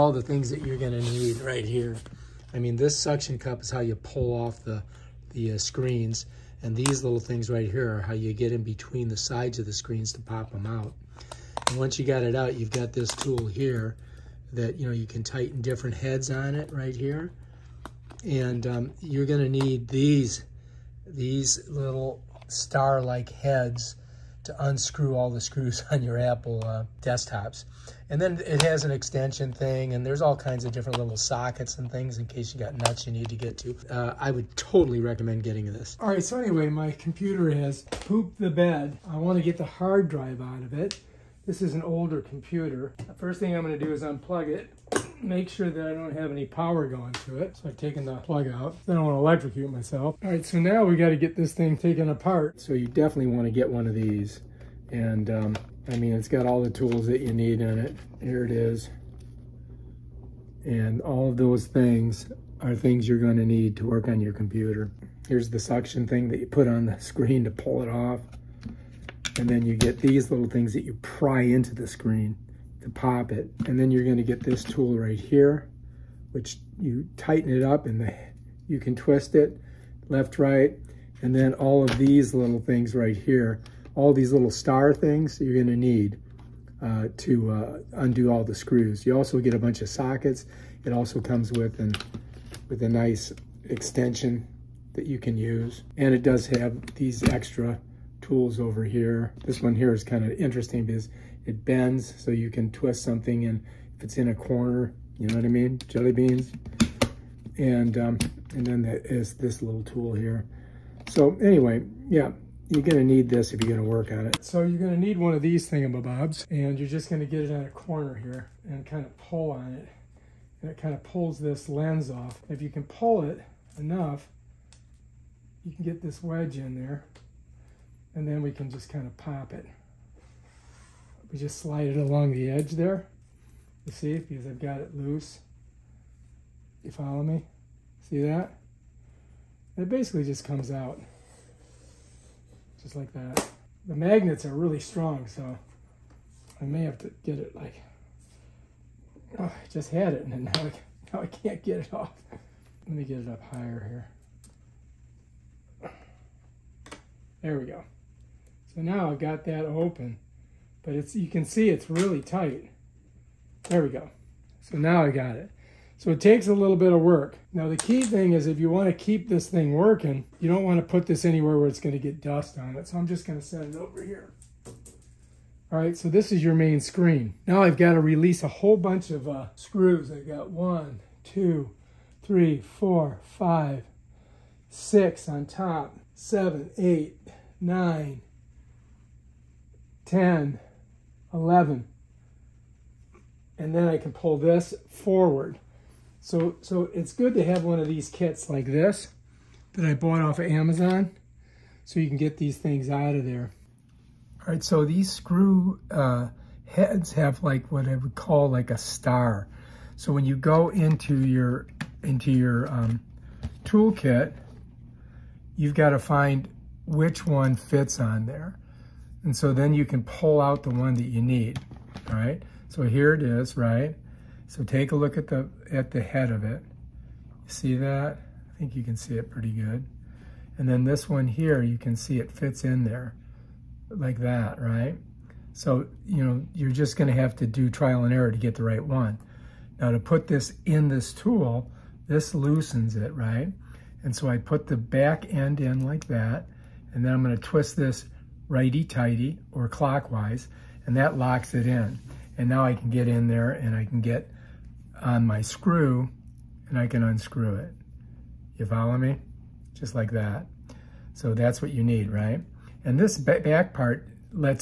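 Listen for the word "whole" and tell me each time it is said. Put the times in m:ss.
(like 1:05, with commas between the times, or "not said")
2:58.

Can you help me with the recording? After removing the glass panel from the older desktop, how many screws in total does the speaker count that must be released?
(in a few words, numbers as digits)
11.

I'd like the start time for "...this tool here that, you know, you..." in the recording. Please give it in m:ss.
0:12.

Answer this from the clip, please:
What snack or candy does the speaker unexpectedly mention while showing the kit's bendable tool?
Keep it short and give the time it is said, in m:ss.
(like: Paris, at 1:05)
Jelly beans, at 1:45.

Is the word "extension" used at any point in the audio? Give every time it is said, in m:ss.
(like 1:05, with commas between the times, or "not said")
0:28, 1:33.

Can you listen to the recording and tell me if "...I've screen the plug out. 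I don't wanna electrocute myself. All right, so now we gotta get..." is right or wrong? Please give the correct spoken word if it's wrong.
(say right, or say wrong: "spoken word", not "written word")
wrong: "taken", not "screen".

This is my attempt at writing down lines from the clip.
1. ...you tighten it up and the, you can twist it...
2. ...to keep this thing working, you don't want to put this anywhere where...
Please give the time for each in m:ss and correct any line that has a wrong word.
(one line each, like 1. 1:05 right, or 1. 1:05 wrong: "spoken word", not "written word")
1. 1:16 right
2. 2:48 right.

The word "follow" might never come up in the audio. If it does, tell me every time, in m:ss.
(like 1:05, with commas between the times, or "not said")
2:16, 4:18.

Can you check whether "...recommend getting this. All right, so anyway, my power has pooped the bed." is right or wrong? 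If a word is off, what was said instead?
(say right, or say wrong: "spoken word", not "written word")
wrong: "computer", not "power".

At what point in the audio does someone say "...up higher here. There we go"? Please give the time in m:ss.
2:33.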